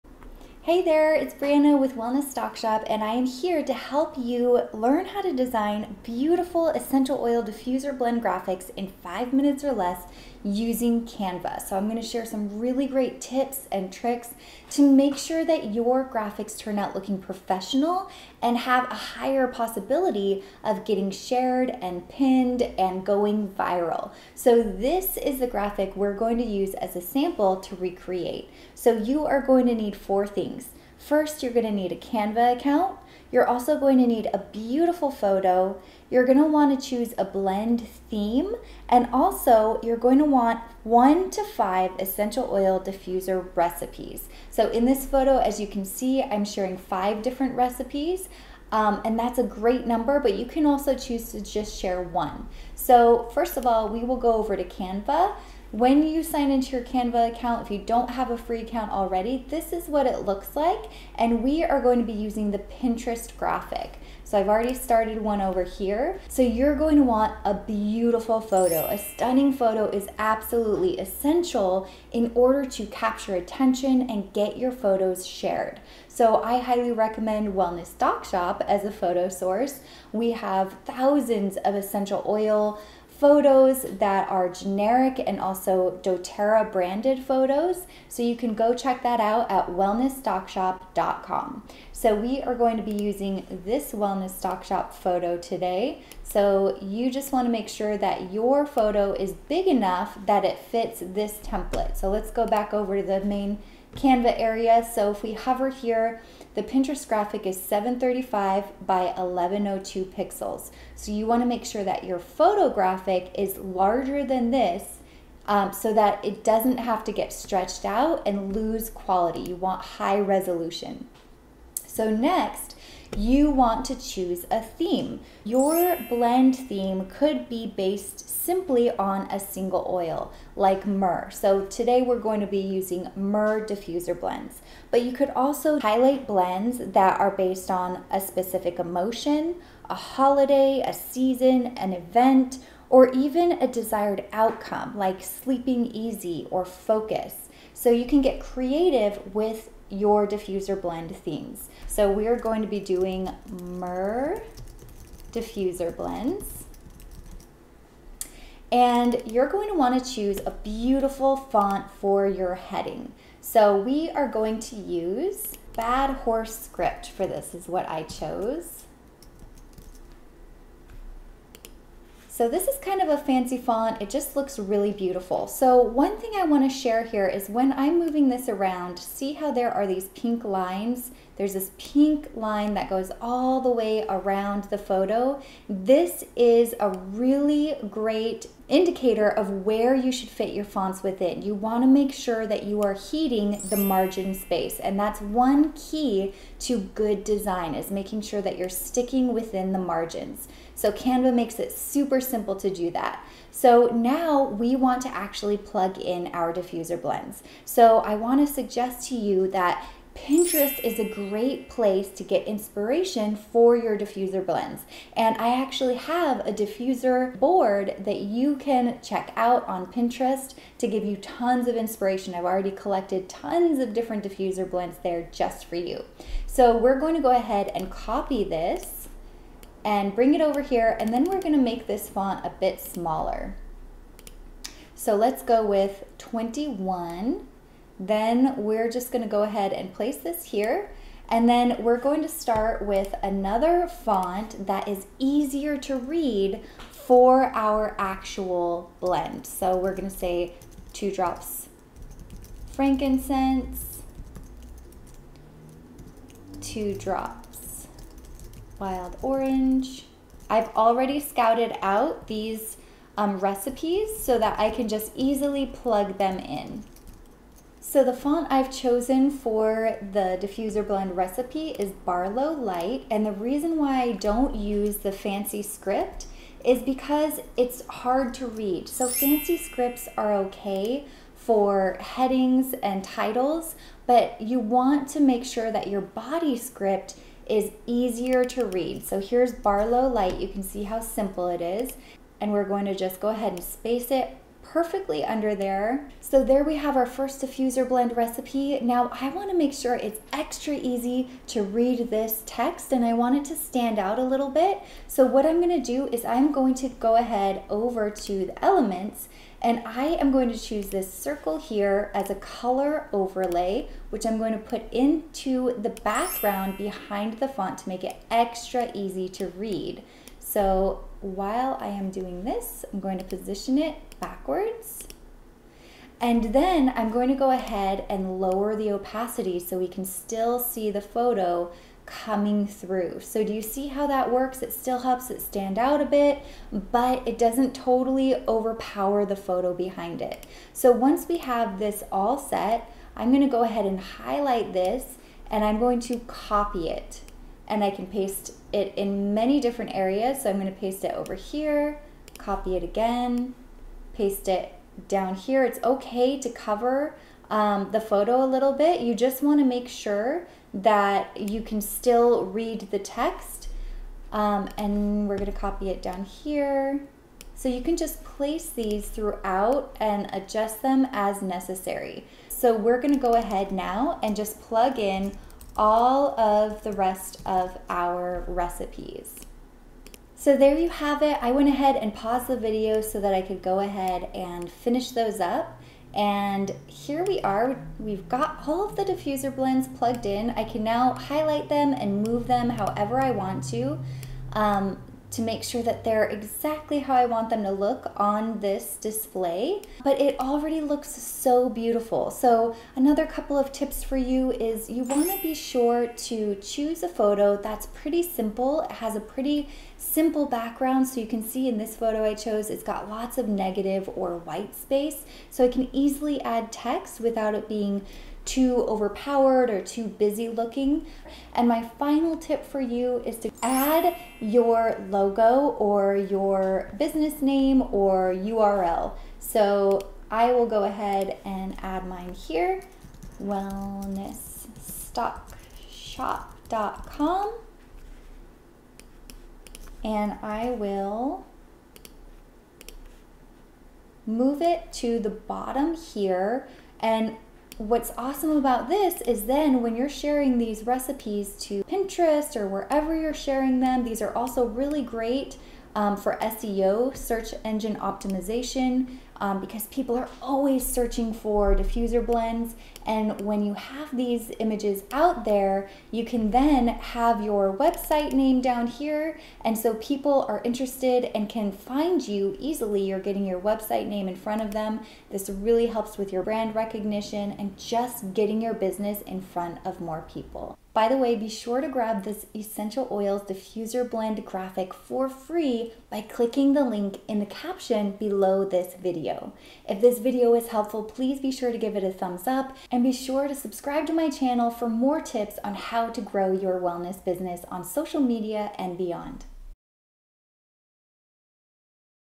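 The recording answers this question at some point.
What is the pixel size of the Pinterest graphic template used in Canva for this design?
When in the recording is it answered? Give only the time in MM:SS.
01:47.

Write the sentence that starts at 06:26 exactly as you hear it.
And here we are, we've got all of the diffuser blends plugged in.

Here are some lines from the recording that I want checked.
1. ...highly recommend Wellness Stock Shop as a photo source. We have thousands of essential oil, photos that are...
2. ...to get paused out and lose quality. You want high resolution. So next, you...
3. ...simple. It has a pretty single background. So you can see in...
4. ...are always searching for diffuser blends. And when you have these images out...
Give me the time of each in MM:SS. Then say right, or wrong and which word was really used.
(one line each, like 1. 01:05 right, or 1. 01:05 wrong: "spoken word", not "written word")
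1. 01:16 right
2. 01:57 wrong: "stretched", not "paused"
3. 06:48 wrong: "simple", not "single"
4. 07:40 right.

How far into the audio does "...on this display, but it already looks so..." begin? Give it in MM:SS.
06:38.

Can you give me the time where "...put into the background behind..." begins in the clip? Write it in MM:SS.
05:14.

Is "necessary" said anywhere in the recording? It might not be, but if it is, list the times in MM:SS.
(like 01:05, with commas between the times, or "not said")
06:11.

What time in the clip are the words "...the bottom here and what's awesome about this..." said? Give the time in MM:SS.
07:25.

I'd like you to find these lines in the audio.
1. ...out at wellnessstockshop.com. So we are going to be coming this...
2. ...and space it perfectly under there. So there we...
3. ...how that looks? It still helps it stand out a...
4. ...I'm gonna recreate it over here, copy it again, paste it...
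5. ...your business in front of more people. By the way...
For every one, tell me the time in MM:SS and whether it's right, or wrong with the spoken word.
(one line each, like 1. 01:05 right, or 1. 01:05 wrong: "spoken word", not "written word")
1. 01:29 wrong: "using", not "coming"
2. 04:53 right
3. 05:33 wrong: "works", not "looks"
4. 05:50 wrong: "paste", not "recreate"
5. 07:58 right.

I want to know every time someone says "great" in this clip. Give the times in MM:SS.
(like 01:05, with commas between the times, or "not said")
00:12, 00:49, 03:07, 03:31, 07:35.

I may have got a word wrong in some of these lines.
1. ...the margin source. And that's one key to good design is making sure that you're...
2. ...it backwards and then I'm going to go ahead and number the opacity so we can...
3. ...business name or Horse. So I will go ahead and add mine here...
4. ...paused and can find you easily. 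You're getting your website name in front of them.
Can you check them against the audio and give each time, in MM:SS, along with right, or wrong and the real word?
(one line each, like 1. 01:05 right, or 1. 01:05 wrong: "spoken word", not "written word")
1. 03:13 wrong: "space", not "source"
2. 05:23 wrong: "lower", not "number"
3. 07:06 wrong: "URL", not "Horse"
4. 07:50 wrong: "interested", not "paused".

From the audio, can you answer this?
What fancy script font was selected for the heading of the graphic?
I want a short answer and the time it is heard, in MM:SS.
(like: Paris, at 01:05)
Bad Horse Script, at 02:45.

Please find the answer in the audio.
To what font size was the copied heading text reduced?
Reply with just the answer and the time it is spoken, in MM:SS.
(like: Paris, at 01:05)
21, at 03:56.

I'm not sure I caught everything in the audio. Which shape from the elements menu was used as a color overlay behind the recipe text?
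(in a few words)
Circle.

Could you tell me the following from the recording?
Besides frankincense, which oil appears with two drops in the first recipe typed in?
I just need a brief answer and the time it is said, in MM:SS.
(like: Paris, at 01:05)
Wild orange, at 04:18.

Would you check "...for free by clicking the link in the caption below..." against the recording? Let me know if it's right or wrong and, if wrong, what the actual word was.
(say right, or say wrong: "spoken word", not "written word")
right.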